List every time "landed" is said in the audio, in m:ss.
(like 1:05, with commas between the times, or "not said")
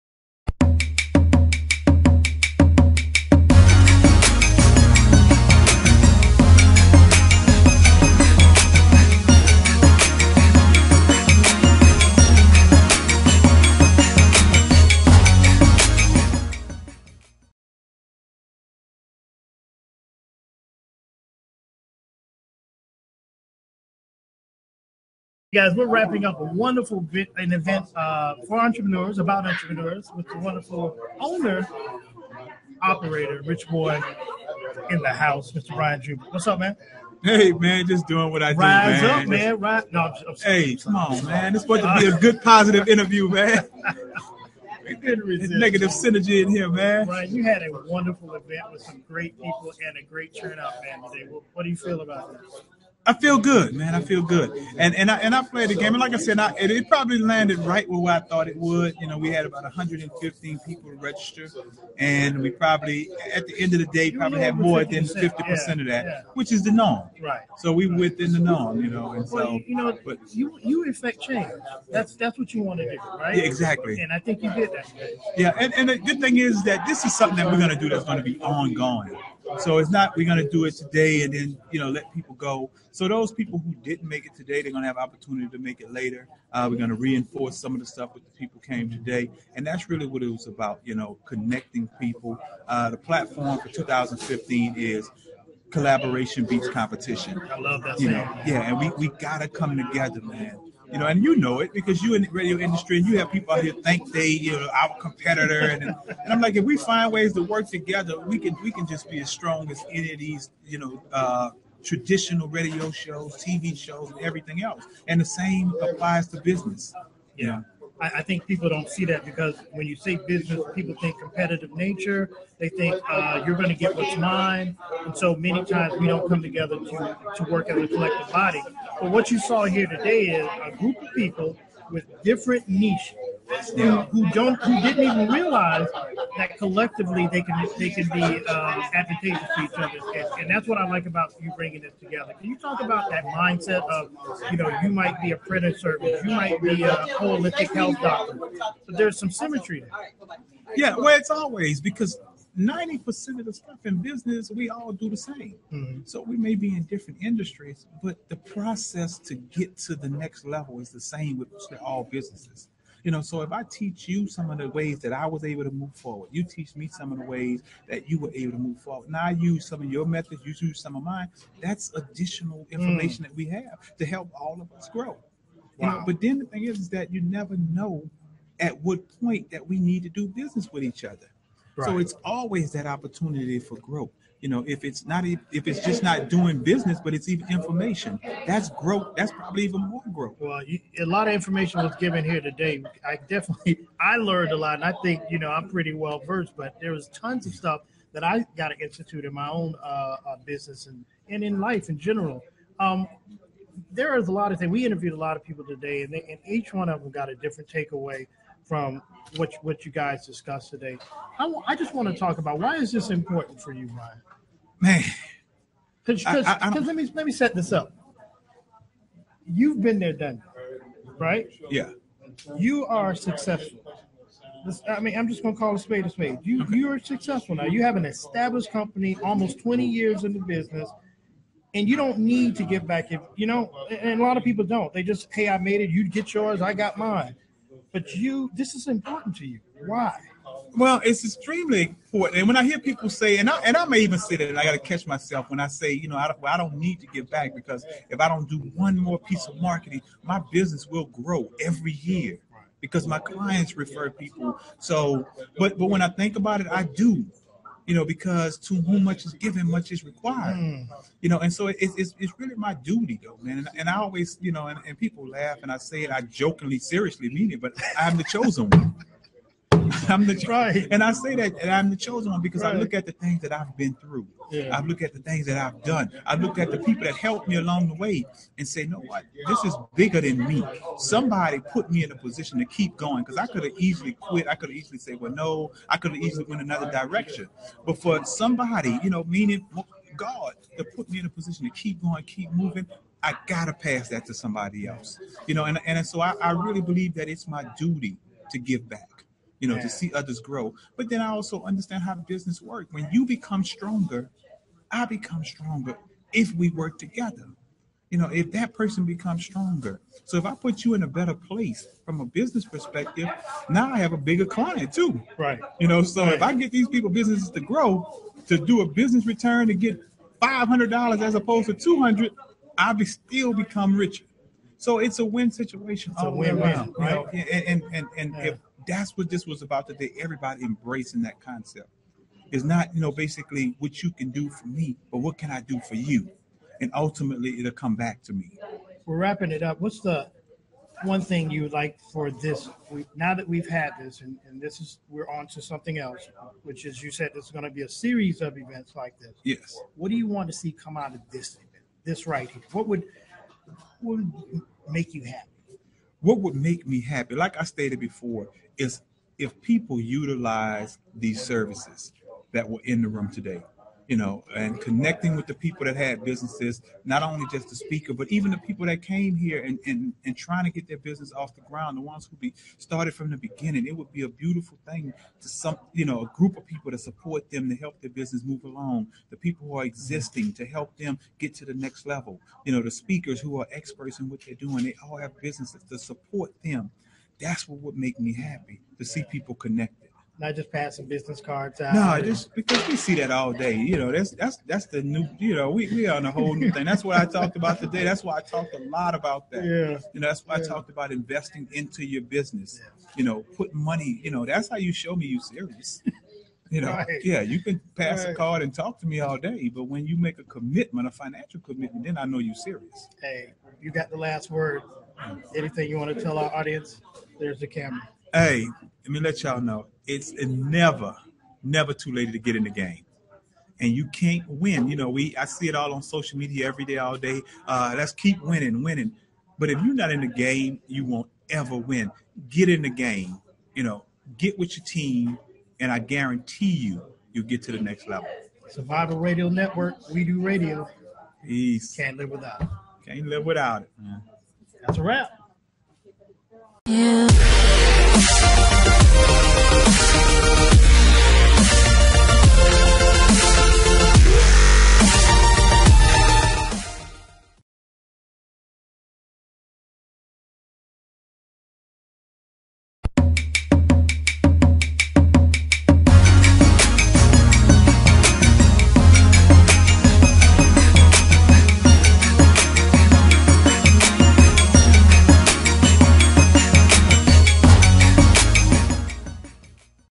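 0:57.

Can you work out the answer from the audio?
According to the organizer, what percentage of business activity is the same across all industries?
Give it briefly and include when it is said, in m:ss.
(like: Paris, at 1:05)
90%, at 2:32.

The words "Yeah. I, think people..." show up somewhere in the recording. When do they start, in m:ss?
1:57.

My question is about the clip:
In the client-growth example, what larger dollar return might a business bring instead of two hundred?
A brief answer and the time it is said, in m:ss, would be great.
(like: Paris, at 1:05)
$500, at 5:20.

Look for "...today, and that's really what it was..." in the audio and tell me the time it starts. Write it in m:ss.
1:28.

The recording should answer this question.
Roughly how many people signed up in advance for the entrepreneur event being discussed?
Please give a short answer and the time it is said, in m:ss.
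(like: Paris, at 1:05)
115, at 0:59.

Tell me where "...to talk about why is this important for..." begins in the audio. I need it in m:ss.
3:32.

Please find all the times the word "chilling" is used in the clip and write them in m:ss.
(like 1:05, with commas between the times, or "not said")
not said.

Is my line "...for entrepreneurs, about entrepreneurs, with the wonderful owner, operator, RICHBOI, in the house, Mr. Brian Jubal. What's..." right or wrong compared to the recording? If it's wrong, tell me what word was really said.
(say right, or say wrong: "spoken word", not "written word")
right.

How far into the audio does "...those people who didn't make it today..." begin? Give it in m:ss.
1:23.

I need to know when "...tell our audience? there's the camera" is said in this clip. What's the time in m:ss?
6:56.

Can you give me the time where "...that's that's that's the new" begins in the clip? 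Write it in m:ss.
6:34.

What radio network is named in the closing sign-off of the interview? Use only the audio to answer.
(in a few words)
Survival Radio Network.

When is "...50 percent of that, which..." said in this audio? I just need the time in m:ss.
1:05.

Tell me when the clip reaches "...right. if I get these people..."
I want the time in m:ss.
5:16.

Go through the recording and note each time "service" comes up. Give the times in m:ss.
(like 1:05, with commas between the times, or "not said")
2:25, 6:01.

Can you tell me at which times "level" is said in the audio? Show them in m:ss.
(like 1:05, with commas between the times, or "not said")
2:40, 6:22, 7:18.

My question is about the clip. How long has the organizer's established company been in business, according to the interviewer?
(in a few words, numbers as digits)
Almost 20 years.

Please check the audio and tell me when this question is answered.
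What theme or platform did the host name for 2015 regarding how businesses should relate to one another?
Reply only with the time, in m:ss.
1:35.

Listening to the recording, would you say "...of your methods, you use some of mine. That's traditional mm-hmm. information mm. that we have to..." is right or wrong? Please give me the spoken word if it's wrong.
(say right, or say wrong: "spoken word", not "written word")
wrong: "additional", not "traditional".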